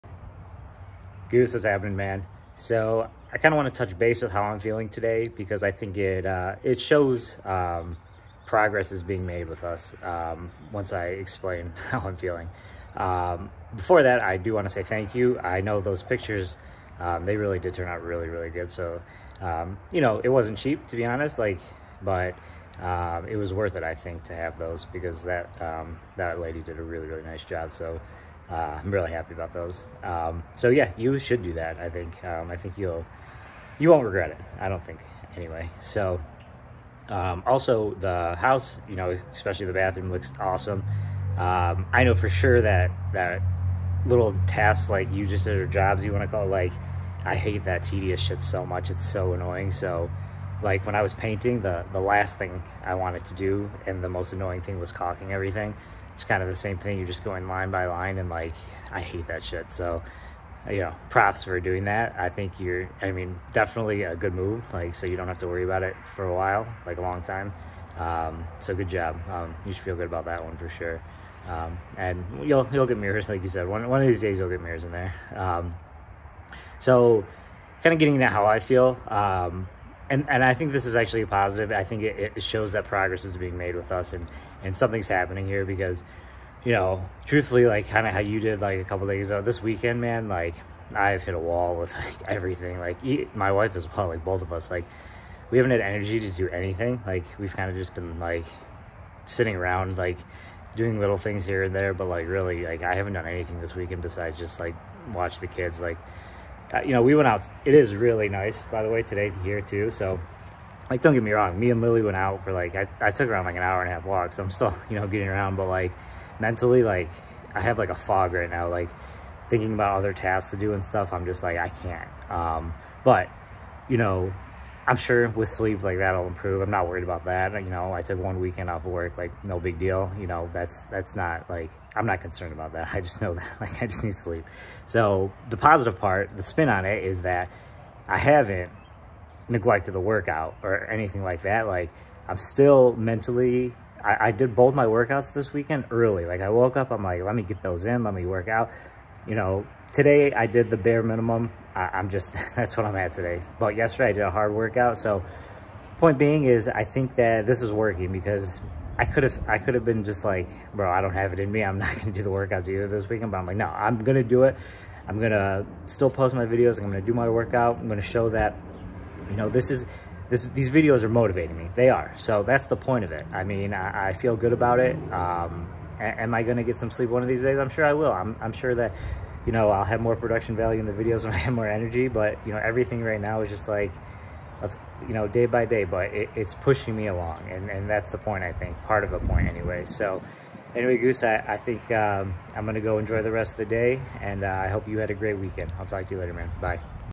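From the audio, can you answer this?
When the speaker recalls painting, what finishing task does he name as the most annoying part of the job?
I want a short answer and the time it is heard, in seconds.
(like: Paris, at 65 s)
caulking, at 54 s.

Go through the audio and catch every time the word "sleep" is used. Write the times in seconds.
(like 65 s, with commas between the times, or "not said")
125 s, 134 s, 176 s.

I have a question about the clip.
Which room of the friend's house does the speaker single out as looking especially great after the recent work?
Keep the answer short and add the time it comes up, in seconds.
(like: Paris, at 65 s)
bathroom, at 39 s.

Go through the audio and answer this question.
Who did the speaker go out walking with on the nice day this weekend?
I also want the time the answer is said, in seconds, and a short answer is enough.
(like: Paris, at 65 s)
Lily, at 111 s.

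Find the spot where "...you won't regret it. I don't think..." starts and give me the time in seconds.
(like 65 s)
33 s.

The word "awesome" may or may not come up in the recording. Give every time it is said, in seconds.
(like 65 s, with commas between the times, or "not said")
40 s.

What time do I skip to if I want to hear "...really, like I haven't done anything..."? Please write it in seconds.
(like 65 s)
102 s.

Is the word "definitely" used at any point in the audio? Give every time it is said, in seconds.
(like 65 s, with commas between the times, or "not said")
63 s.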